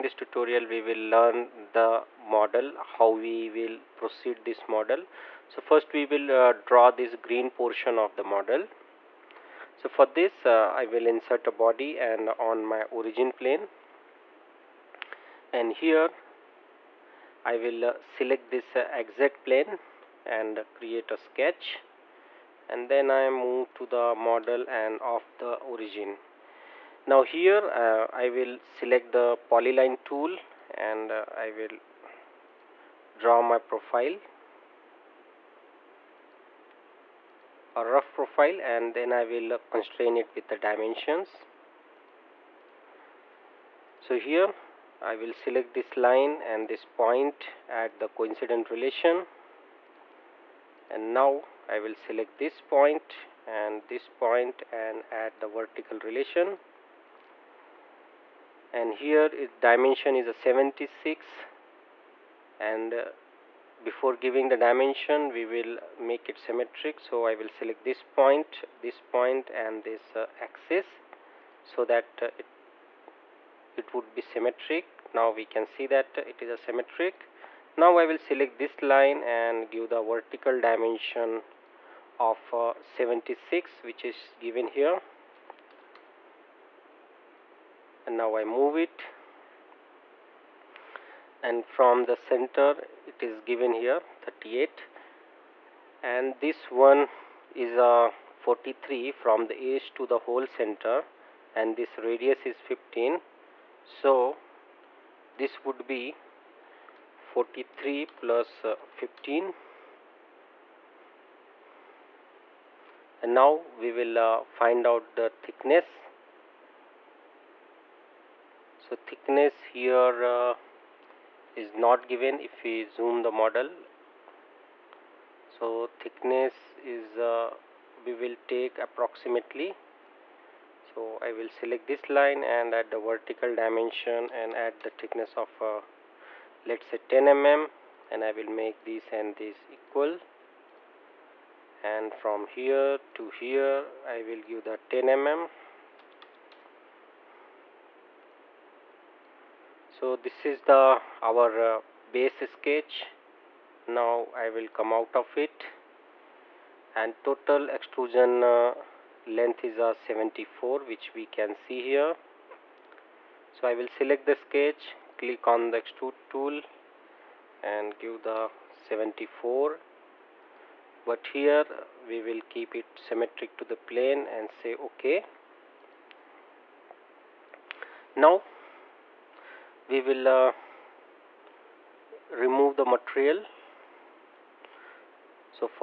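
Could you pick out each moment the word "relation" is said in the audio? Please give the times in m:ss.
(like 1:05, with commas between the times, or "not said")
0:48, 0:55.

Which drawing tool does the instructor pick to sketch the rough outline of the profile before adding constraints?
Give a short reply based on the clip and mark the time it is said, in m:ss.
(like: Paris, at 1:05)
polyline, at 0:29.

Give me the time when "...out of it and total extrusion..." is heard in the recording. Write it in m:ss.
2:34.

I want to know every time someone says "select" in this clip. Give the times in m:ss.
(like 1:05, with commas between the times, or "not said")
0:17, 0:28, 0:45, 0:51, 1:07, 1:18, 2:11, 2:43.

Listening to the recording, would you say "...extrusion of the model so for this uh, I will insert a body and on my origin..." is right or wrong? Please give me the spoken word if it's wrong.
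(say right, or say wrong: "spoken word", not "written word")
wrong: "portion", not "extrusion".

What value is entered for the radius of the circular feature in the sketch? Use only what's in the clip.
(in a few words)
15.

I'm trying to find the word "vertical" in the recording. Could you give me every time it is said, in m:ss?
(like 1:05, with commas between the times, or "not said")
0:55, 1:19, 2:13.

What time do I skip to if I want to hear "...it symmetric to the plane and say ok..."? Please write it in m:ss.
2:52.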